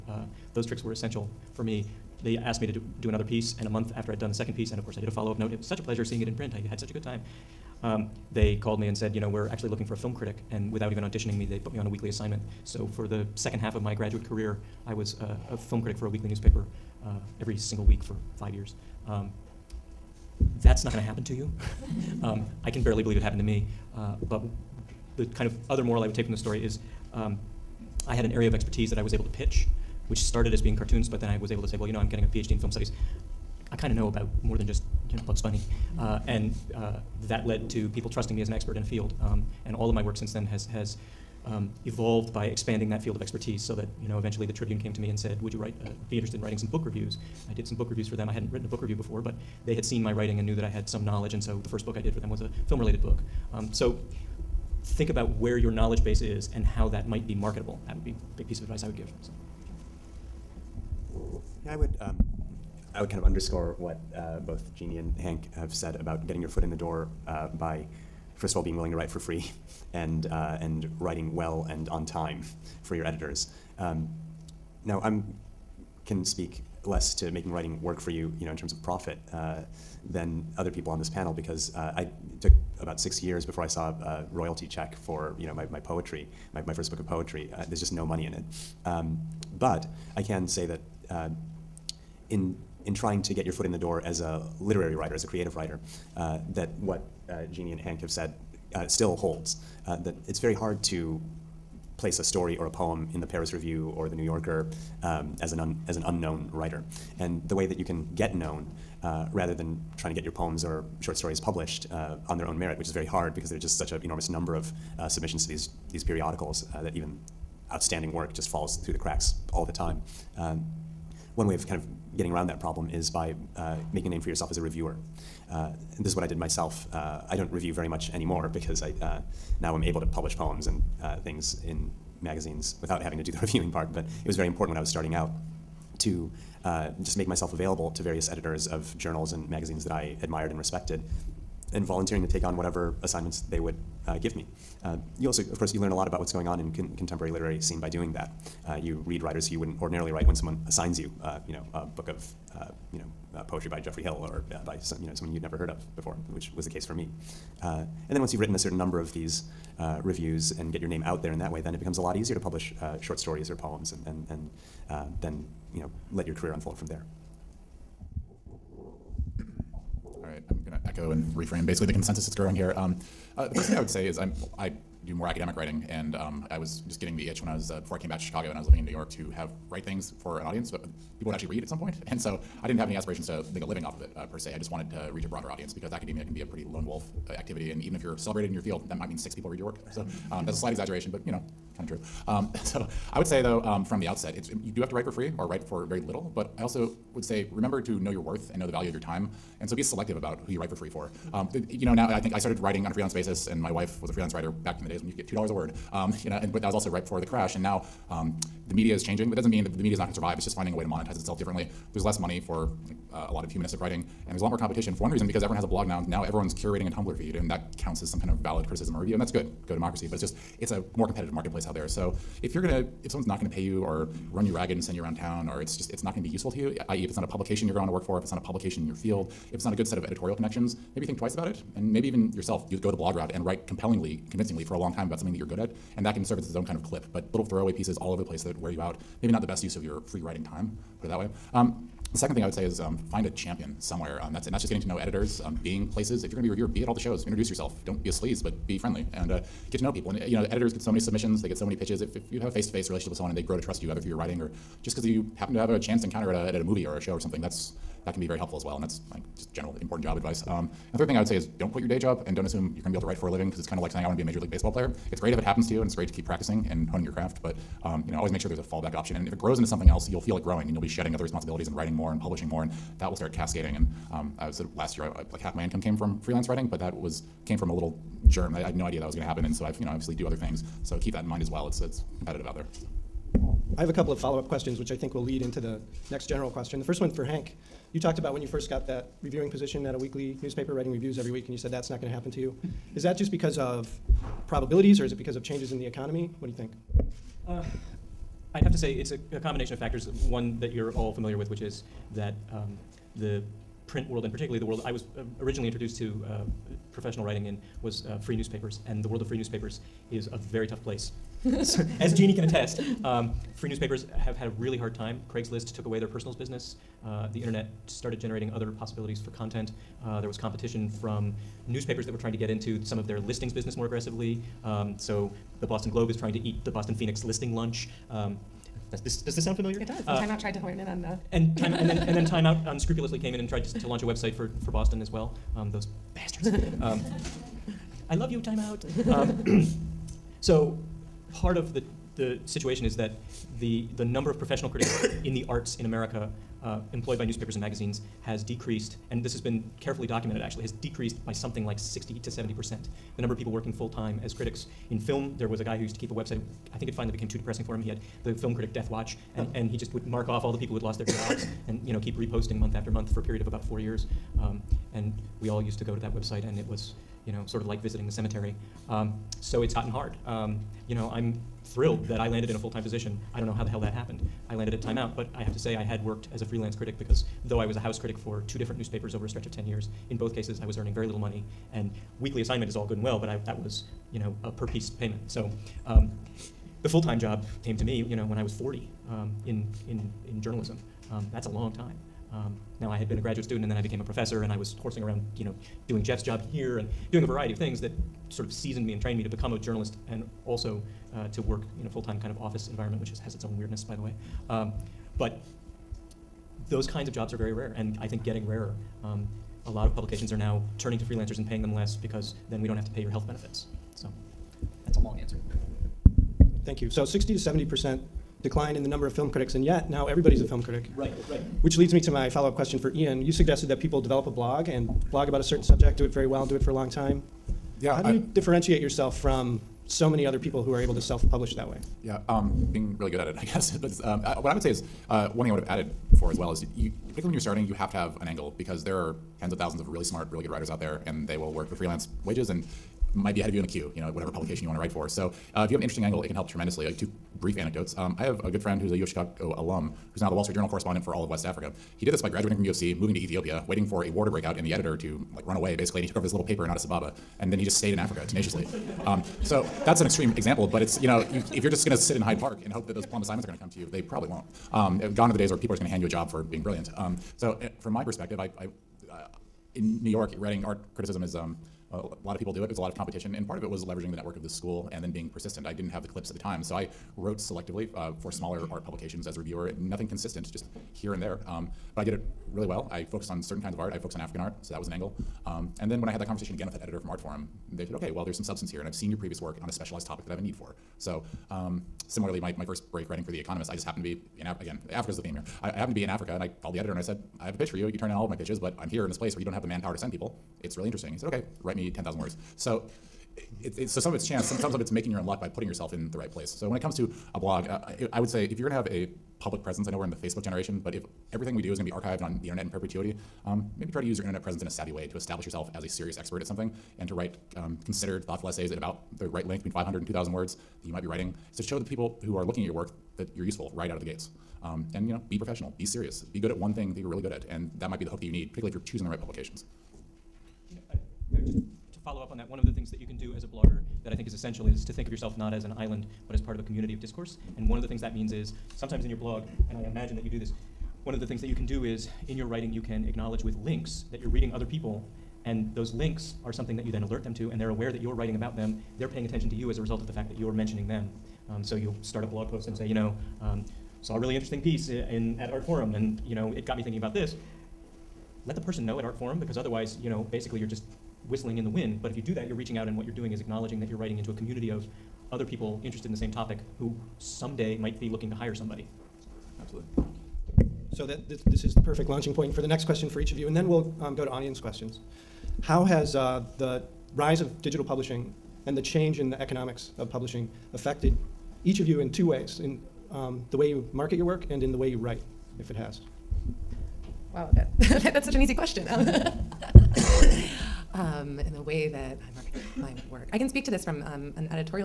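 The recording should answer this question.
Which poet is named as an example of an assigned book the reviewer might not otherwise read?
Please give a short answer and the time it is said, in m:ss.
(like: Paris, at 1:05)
Geoffrey Hill, at 2:33.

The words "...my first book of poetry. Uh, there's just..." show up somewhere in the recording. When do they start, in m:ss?
1:26.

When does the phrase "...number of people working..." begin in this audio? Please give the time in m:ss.
5:53.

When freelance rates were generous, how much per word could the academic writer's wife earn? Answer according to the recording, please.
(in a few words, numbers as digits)
2 dollars.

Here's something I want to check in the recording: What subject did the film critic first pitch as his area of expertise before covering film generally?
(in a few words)
Cartoons.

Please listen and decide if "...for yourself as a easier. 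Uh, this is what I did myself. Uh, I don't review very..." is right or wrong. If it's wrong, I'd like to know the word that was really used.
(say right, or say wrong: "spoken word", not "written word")
wrong: "reviewer", not "easier".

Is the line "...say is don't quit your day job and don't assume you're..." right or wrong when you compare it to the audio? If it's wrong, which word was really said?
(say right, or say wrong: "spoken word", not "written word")
right.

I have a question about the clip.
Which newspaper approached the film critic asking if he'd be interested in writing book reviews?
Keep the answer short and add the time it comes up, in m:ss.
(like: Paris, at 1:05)
The Tribune, at 0:44.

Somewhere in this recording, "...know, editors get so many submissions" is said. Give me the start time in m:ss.
4:10.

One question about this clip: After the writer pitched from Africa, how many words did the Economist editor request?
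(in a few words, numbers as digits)
10,000.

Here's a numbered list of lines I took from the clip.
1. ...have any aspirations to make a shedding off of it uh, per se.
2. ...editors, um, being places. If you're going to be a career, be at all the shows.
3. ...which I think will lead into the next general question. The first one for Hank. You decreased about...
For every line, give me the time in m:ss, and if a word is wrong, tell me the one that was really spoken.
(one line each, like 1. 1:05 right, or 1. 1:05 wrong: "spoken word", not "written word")
1. 3:02 wrong: "living", not "shedding"
2. 4:04 wrong: "reviewer", not "career"
3. 4:44 wrong: "talked", not "decreased".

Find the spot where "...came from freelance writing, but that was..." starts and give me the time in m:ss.
4:35.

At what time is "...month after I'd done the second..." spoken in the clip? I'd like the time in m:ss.
0:03.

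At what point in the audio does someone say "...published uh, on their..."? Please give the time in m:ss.
1:51.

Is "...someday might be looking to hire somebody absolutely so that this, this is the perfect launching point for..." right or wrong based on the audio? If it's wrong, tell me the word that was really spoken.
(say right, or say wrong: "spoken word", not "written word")
right.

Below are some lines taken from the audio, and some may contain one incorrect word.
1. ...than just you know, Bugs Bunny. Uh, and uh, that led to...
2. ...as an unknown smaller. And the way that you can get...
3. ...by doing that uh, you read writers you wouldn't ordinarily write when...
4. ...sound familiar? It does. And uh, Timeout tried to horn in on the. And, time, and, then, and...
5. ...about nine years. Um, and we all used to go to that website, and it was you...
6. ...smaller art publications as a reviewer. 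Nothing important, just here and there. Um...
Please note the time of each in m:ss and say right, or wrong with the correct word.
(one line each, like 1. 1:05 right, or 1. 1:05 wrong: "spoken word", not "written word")
1. 0:34 right
2. 1:45 wrong: "writer", not "smaller"
3. 2:27 right
4. 5:29 right
5. 6:03 wrong: "four", not "nine"
6. 7:58 wrong: "consistent", not "important".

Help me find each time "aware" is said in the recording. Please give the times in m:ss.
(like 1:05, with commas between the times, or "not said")
9:07.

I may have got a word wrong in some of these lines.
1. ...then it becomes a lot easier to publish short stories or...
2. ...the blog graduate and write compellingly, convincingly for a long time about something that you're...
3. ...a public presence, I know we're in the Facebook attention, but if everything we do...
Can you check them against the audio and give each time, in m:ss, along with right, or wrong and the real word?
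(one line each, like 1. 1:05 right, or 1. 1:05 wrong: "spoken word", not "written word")
1. 2:41 right
2. 3:52 wrong: "route", not "graduate"
3. 8:28 wrong: "generation", not "attention".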